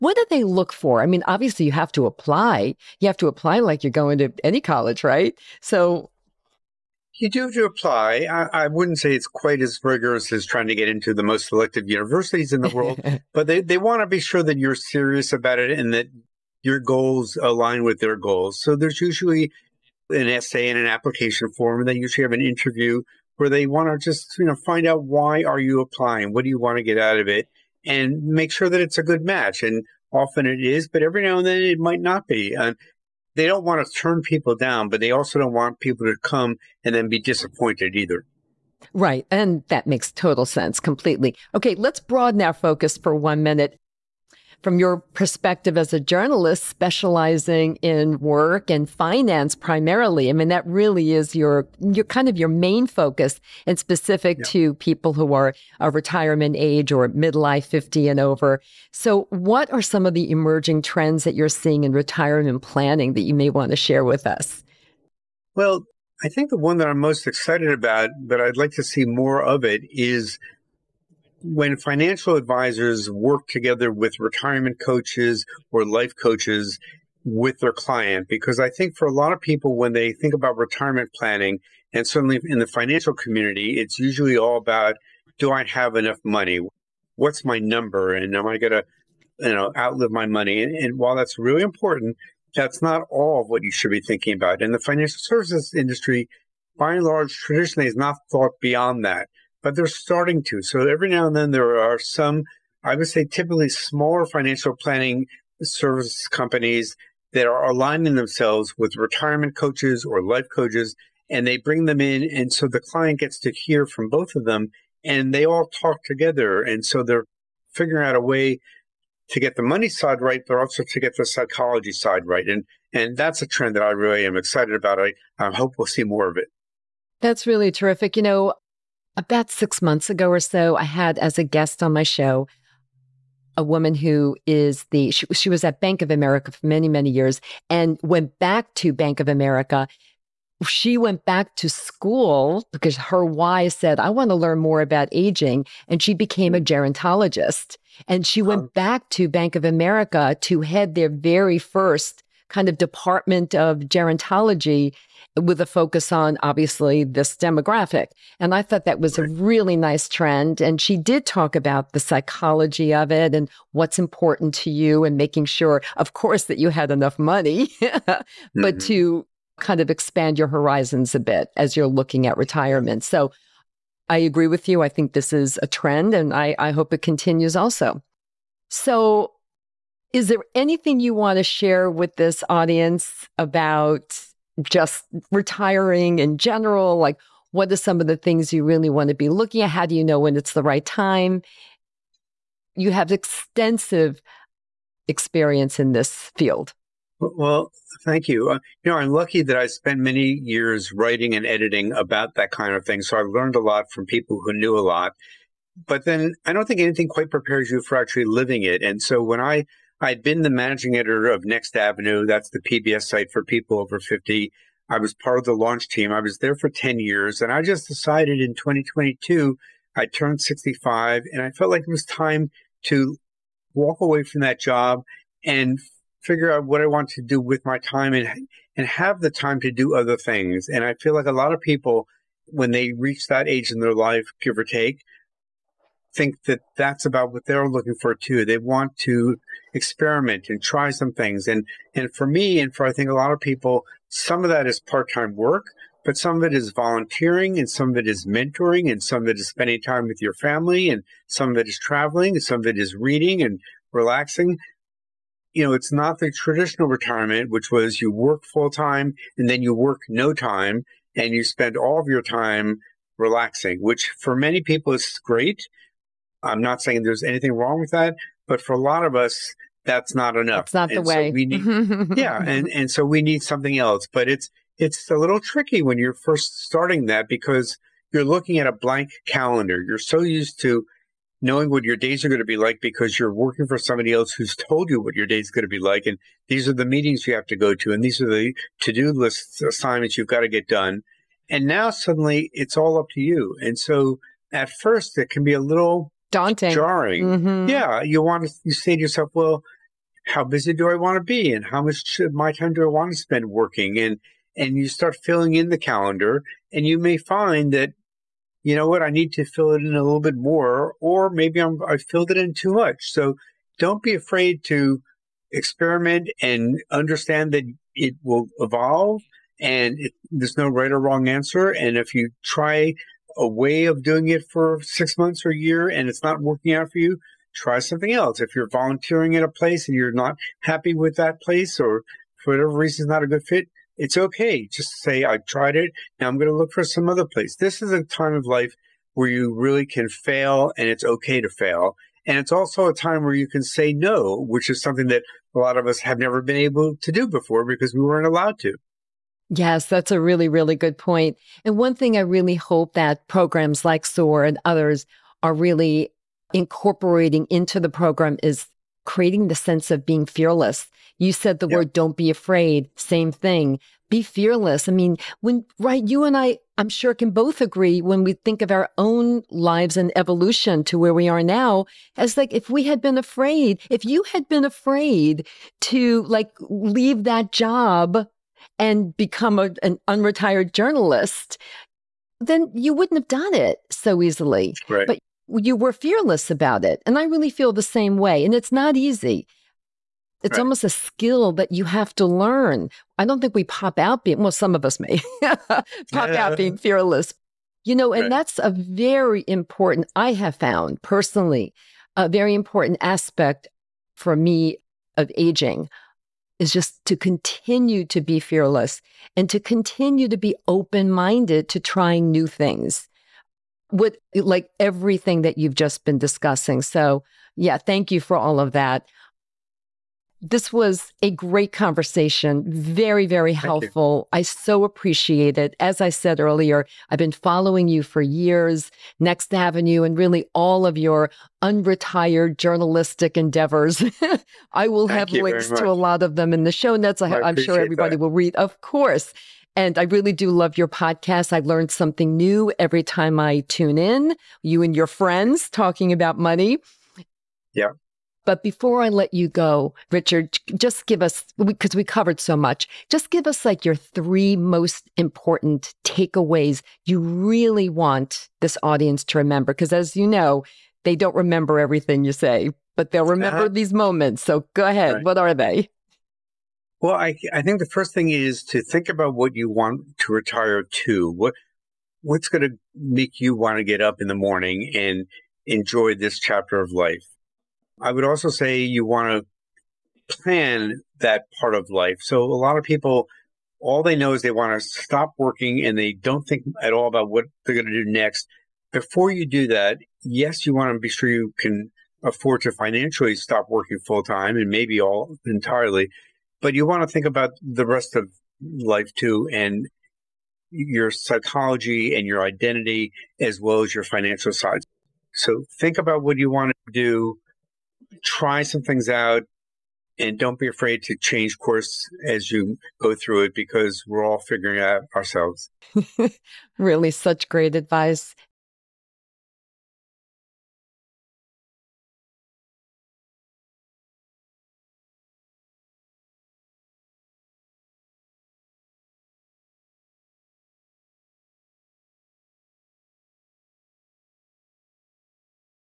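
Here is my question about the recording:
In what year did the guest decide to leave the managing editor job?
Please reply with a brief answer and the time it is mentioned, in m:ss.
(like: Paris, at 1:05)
2022, at 3:38.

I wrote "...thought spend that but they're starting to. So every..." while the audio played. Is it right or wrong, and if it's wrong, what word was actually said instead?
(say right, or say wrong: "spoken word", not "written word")
wrong: "beyond", not "spend".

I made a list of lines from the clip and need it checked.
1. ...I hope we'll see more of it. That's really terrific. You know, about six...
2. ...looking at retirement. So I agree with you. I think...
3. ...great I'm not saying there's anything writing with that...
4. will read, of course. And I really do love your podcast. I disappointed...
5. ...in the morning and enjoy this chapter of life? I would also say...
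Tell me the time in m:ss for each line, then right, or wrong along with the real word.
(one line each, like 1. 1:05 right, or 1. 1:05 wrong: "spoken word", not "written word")
1. 2:05 right
2. 2:51 right
3. 4:25 wrong: "wrong", not "writing"
4. 7:18 wrong: "learned", not "disappointed"
5. 7:54 right.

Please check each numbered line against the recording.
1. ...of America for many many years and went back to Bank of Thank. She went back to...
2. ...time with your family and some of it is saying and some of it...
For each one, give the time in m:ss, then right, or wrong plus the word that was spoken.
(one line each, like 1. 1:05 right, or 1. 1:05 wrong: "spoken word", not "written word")
1. 2:16 wrong: "America", not "Thank"
2. 4:09 wrong: "traveling", not "saying".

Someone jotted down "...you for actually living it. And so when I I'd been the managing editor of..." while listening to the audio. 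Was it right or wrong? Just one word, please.
right.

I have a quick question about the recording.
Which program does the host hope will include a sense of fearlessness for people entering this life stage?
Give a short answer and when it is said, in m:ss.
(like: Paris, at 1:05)
SOAR, at 5:54.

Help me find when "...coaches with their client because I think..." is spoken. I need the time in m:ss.
1:16.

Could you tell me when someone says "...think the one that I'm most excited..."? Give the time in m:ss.
1:06.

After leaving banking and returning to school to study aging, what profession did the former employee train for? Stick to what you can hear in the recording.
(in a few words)
gerontologist.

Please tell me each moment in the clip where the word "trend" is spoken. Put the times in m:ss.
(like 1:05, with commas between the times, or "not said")
1:00, 2:03, 2:40, 2:55.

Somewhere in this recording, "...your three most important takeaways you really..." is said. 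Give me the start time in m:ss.
7:33.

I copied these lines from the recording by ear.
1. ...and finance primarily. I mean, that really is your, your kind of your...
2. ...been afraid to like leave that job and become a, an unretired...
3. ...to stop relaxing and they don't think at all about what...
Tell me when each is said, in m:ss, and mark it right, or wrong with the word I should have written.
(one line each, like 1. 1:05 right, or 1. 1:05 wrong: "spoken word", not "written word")
1. 0:48 right
2. 6:14 right
3. 8:04 wrong: "working", not "relaxing".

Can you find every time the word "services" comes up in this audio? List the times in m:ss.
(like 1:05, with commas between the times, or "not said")
1:35, 1:45.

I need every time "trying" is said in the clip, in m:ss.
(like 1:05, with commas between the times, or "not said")
0:10, 6:51.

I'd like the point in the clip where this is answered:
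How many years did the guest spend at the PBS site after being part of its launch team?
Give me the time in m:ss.
3:36.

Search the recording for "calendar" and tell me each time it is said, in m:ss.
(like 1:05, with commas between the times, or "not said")
4:39, 5:05.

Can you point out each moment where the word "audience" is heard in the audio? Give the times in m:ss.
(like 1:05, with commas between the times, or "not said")
3:02, 7:38.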